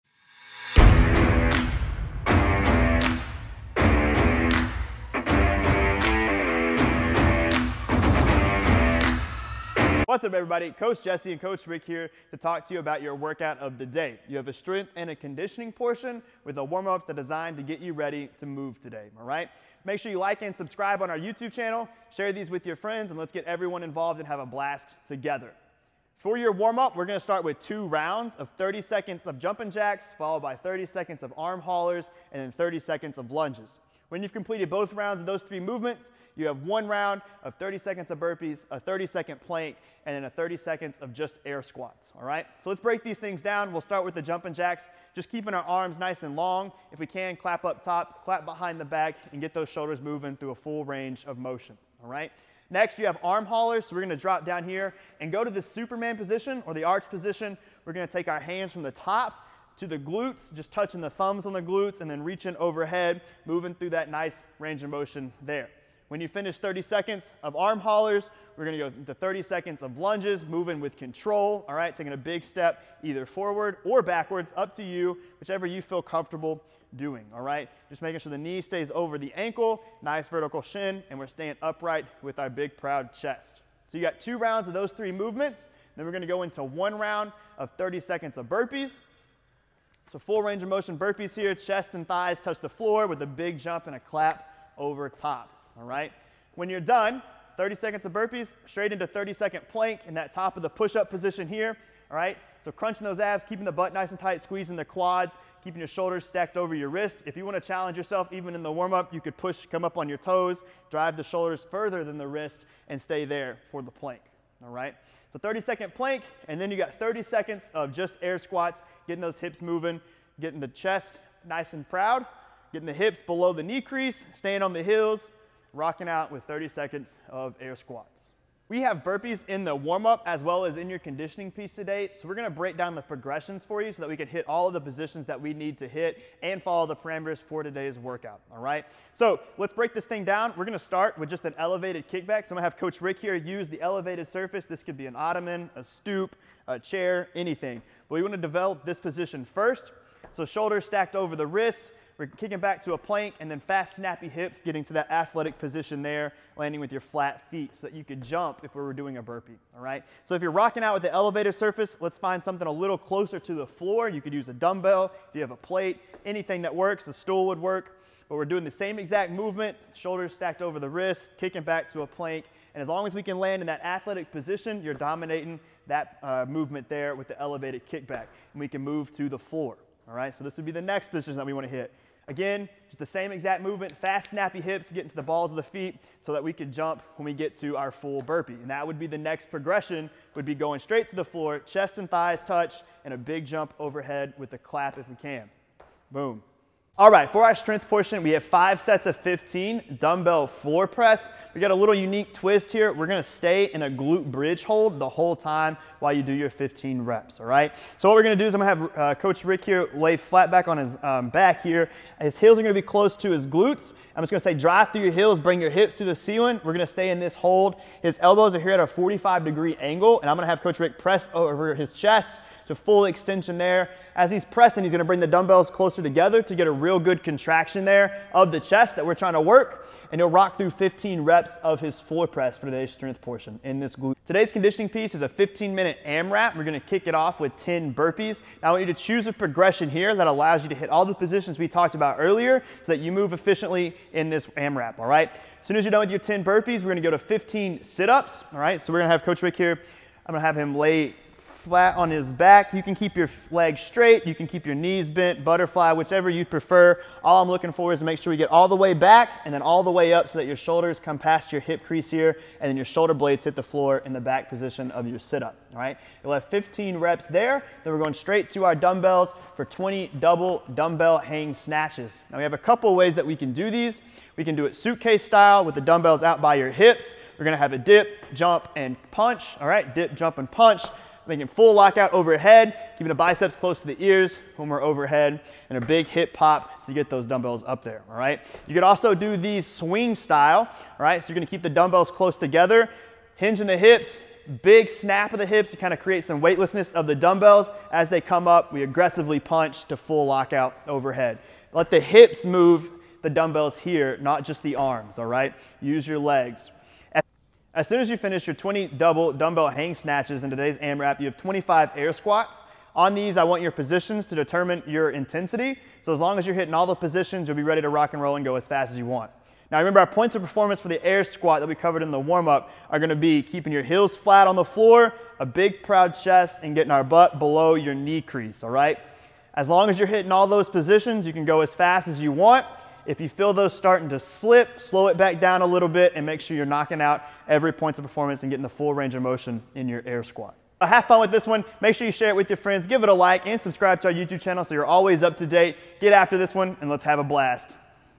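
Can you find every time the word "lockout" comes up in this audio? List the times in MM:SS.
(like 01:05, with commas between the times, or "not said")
04:41, 05:00.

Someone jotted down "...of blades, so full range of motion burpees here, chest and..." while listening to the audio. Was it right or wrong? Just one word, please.
wrong.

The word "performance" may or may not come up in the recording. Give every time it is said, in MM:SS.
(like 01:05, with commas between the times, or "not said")
05:20, 05:38.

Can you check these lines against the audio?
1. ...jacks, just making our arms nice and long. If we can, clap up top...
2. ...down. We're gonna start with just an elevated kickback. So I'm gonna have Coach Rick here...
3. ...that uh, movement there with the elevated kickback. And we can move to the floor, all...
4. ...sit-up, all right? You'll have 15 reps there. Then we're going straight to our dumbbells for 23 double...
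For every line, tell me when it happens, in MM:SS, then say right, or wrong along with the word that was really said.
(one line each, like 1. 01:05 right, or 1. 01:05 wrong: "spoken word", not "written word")
1. 00:44 wrong: "keeping", not "making"
2. 02:20 right
3. 02:55 right
4. 04:25 wrong: "20", not "23".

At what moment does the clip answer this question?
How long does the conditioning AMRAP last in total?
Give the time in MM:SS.
03:55.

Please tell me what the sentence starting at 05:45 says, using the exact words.
Get after this one and let's have a blast.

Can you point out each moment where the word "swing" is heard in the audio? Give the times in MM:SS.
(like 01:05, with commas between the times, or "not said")
04:49.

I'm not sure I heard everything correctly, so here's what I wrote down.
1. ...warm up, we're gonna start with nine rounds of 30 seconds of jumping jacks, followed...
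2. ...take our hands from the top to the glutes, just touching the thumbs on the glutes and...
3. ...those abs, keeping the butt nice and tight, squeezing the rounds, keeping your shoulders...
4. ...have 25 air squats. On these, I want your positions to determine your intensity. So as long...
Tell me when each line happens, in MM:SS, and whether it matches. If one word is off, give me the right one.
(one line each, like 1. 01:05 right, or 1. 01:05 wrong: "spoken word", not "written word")
1. 00:26 wrong: "two", not "nine"
2. 00:58 right
3. 01:43 wrong: "quads", not "rounds"
4. 05:11 right.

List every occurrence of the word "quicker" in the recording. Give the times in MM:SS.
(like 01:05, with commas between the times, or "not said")
not said.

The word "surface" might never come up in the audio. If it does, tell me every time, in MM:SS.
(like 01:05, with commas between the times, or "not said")
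02:24, 02:41.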